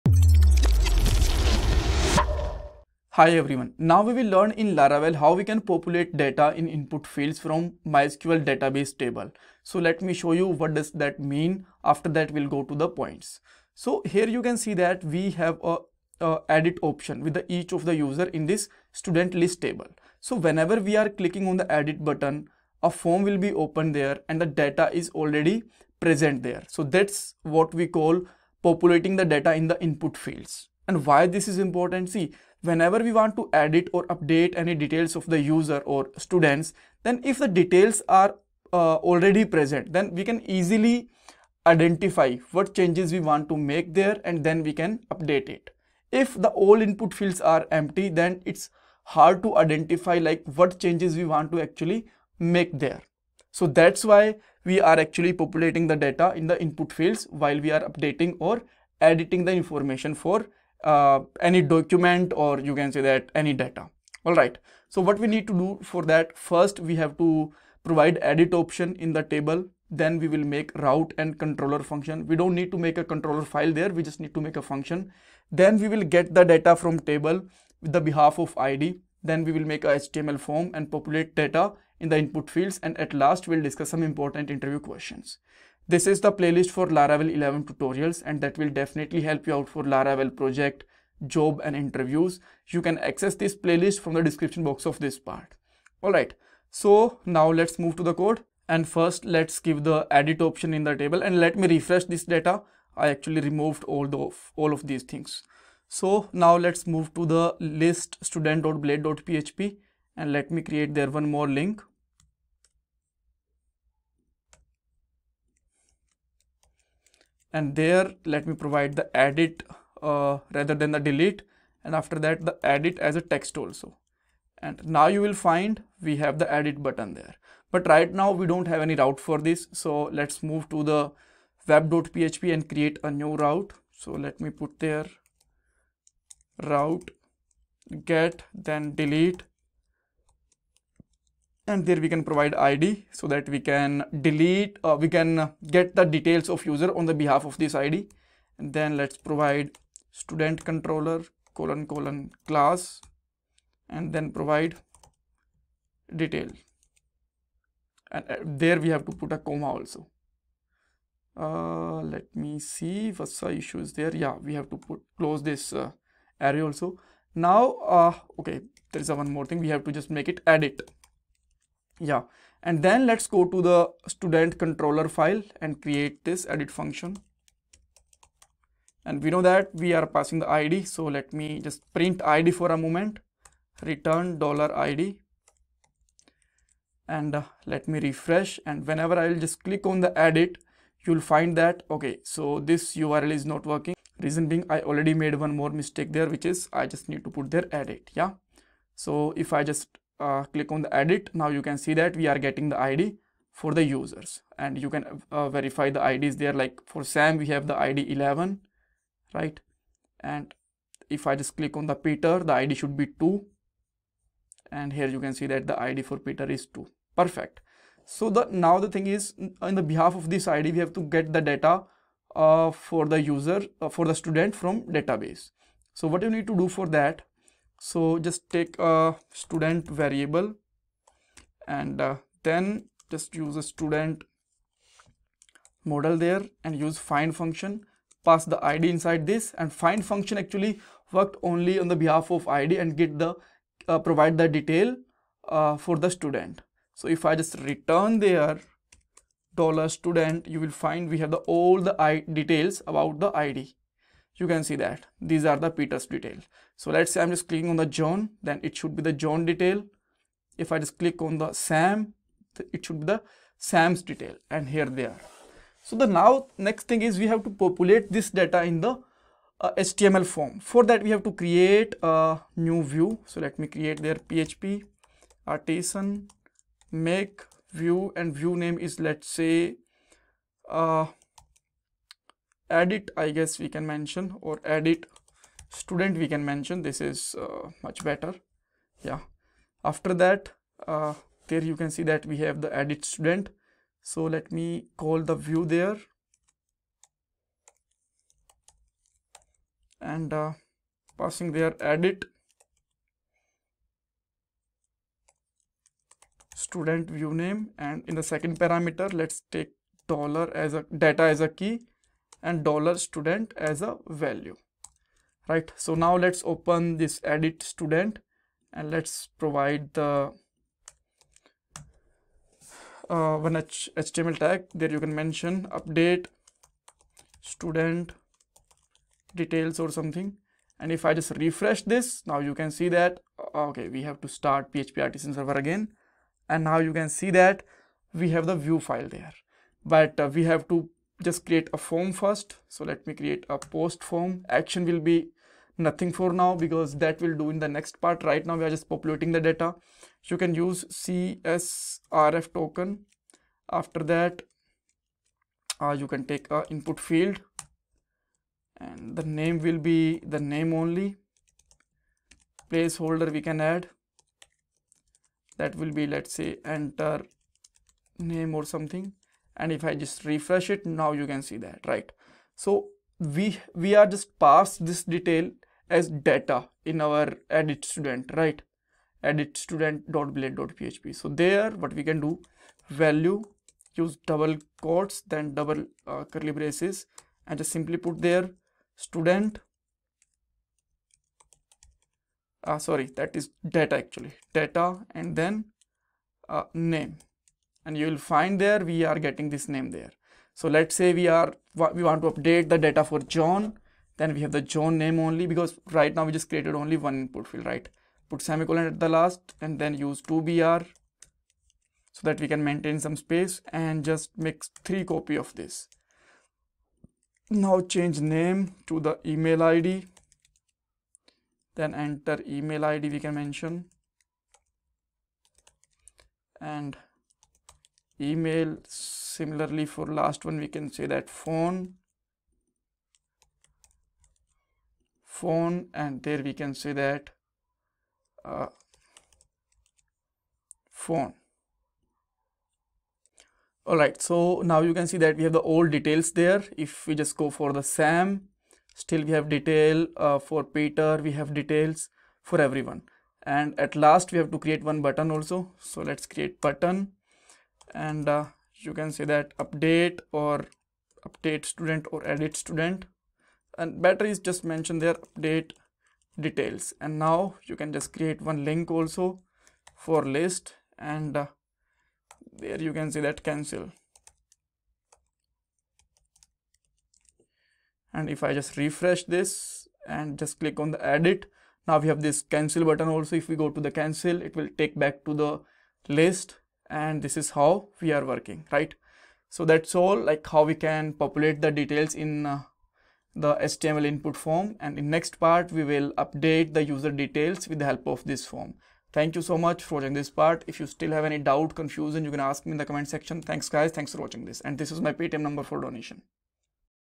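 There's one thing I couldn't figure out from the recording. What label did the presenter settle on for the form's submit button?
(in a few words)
update details.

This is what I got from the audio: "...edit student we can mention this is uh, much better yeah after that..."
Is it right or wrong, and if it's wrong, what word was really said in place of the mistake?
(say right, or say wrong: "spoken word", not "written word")
right.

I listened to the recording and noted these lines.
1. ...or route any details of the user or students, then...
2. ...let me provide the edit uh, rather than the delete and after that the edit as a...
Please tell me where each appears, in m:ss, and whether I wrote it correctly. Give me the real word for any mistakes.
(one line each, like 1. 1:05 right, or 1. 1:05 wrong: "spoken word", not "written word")
1. 0:33 wrong: "update", not "route"
2. 1:58 right.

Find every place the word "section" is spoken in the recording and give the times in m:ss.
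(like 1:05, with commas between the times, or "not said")
8:23.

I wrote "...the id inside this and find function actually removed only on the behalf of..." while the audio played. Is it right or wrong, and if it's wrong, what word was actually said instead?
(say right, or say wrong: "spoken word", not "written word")
wrong: "worked", not "removed".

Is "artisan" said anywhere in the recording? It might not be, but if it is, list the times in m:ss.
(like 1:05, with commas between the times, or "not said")
4:35, 5:35.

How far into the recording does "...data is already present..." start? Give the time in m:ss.
0:24.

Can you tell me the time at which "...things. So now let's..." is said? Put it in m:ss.
1:45.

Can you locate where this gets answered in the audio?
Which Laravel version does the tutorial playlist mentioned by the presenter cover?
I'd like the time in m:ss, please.
1:26.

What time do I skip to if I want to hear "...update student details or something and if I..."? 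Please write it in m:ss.
5:25.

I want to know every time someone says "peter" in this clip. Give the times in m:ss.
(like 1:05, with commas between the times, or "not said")
3:32, 3:36, 4:15, 7:30.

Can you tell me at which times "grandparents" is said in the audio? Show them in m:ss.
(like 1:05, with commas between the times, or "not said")
not said.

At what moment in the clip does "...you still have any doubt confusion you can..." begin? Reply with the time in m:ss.
8:20.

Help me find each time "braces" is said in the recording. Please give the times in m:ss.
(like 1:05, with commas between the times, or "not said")
6:26.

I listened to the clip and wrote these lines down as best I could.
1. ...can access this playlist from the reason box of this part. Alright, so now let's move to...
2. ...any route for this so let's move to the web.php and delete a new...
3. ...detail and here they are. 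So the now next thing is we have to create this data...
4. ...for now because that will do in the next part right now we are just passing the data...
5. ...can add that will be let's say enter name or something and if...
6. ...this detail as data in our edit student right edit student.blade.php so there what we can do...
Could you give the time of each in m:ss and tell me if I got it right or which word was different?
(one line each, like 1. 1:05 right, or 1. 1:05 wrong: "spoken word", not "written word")
1. 1:32 wrong: "description", not "reason"
2. 2:08 wrong: "create", not "delete"
3. 4:24 wrong: "populate", not "create"
4. 5:46 wrong: "populating", not "passing"
5. 6:03 right
6. 6:14 right.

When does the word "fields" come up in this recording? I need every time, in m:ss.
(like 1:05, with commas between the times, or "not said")
0:07, 0:30, 0:47, 0:56, 1:22, 5:56, 6:47.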